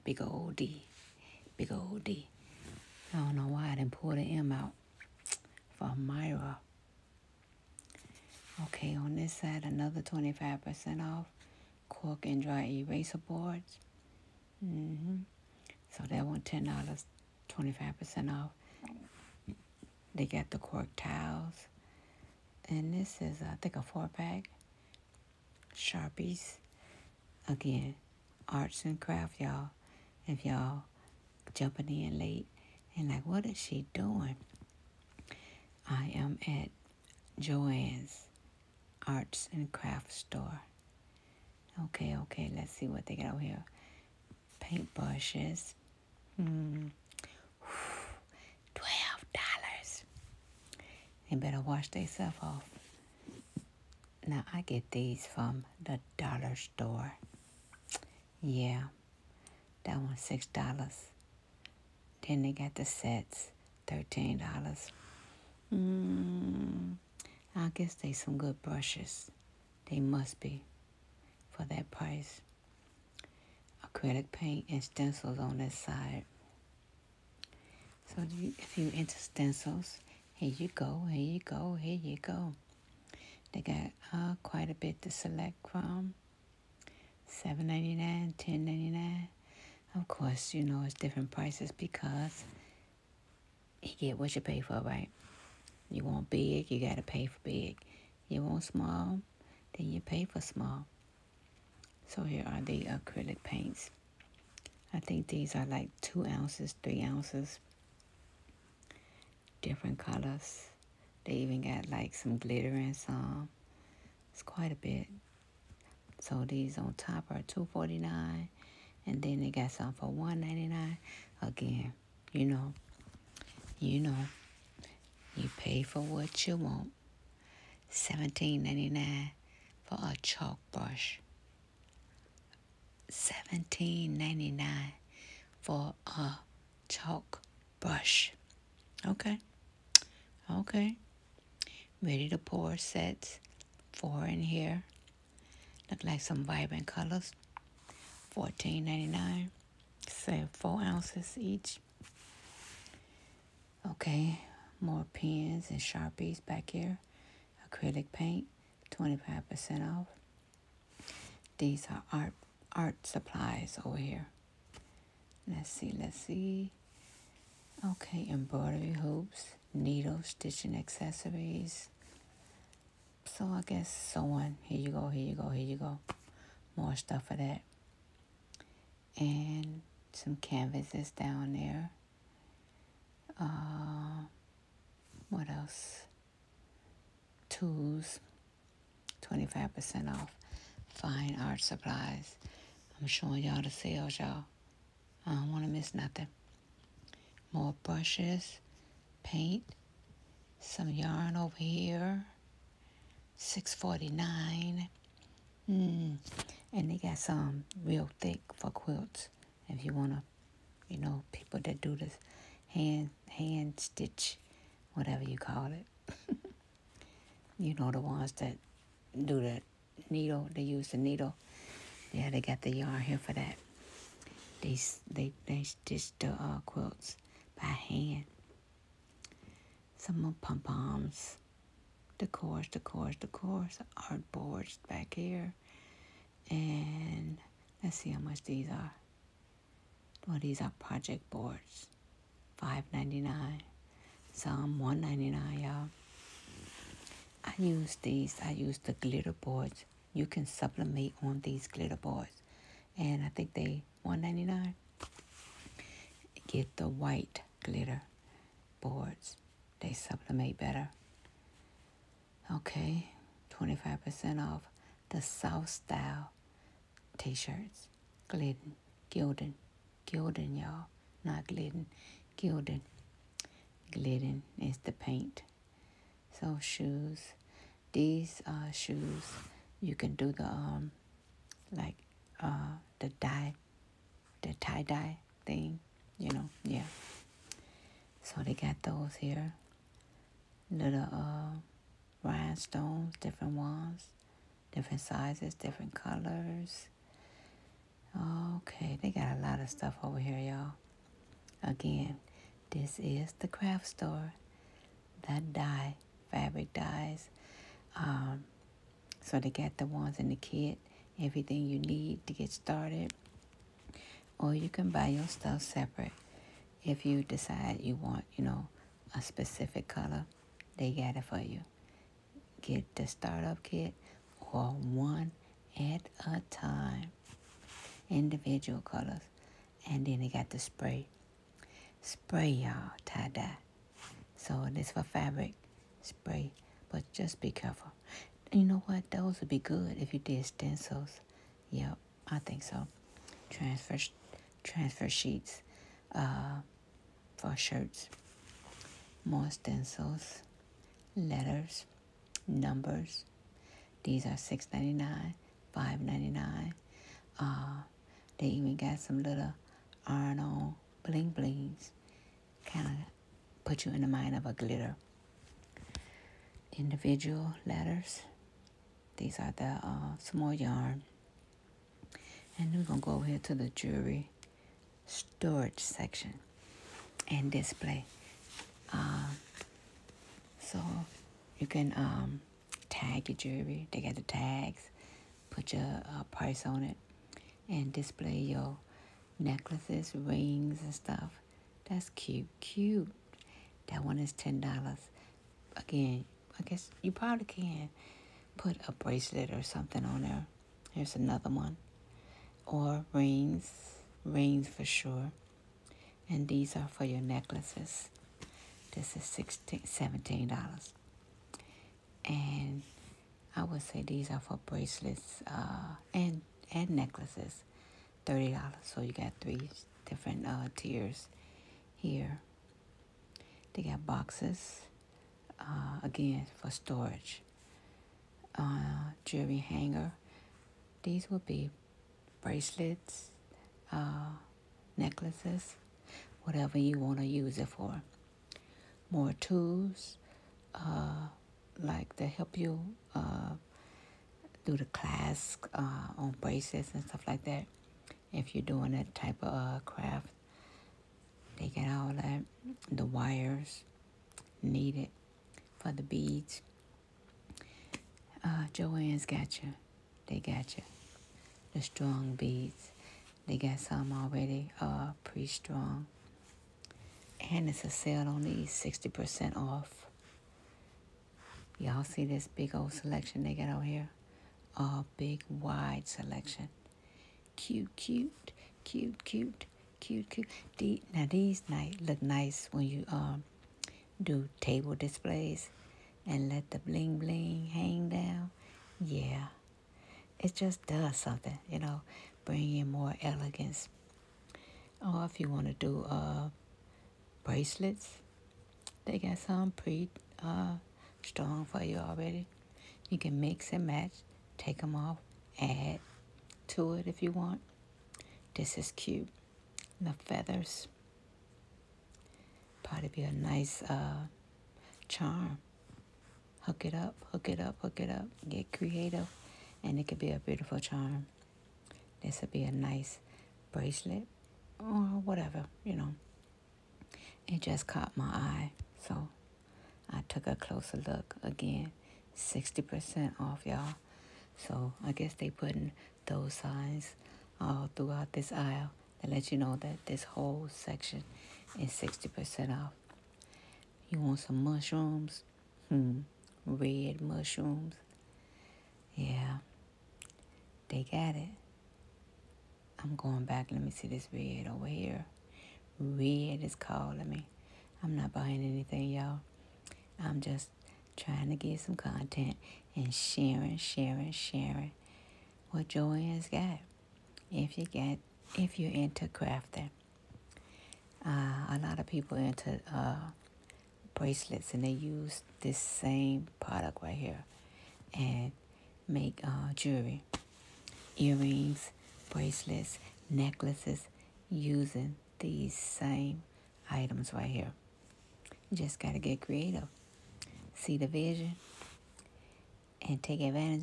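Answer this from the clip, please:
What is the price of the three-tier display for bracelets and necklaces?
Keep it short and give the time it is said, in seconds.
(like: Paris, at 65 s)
$30, at 418 s.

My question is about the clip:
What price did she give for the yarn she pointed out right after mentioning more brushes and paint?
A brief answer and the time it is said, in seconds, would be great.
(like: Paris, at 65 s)
$6.49, at 203 s.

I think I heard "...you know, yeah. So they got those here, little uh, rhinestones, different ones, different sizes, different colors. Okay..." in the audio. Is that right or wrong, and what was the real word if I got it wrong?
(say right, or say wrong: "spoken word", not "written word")
right.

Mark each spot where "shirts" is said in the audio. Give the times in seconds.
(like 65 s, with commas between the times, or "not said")
267 s, 347 s.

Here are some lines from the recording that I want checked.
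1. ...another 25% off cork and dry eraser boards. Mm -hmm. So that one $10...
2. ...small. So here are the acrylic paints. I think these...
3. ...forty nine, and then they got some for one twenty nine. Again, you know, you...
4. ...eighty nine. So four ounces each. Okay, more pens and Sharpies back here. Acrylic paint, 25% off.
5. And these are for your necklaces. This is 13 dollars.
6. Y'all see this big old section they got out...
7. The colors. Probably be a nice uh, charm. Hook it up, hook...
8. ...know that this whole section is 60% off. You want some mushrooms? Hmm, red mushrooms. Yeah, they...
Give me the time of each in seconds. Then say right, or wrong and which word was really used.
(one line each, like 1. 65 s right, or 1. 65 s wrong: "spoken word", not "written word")
1. 9 s right
2. 100 s right
3. 117 s wrong: "ninety", not "twenty"
4. 148 s wrong: "ninety", not "eighty"
5. 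406 s wrong: "16", not "13"
6. 471 s wrong: "selection", not "section"
7. 509 s wrong: "feathers", not "colors"
8. 539 s right.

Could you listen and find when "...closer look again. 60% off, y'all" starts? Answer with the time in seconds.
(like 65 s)
530 s.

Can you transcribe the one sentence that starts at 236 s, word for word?
And let's see how much these are.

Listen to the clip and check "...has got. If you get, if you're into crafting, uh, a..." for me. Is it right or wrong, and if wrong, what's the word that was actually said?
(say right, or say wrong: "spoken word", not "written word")
right.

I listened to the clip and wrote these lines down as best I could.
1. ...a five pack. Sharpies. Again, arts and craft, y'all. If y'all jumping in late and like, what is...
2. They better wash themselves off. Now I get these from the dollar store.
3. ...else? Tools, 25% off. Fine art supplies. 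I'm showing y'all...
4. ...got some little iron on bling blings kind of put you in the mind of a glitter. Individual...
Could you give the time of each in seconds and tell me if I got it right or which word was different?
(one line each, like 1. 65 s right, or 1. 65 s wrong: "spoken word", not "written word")
1. 23 s wrong: "four", not "five"
2. 51 s right
3. 185 s right
4. 358 s right.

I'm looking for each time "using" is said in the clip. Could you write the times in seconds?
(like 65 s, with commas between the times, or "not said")
584 s.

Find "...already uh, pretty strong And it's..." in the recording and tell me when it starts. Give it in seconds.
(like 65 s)
464 s.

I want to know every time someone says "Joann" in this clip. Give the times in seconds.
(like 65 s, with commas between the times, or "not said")
37 s, 458 s.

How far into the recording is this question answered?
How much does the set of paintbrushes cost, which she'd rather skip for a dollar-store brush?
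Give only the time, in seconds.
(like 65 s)
63 s.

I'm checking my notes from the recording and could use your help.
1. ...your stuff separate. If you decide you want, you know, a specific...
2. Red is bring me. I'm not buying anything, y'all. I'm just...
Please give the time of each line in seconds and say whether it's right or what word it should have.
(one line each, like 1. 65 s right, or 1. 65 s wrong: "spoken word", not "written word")
1. 315 s right
2. 555 s wrong: "calling", not "bring".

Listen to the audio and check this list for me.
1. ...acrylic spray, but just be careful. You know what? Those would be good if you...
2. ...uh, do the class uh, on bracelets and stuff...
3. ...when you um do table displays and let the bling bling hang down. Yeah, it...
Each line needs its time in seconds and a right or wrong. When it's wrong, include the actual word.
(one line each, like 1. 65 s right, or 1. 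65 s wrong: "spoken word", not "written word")
1. 335 s wrong: "fabric", not "acrylic"
2. 443 s right
3. 482 s right.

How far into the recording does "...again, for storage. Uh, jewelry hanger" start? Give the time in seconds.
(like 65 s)
426 s.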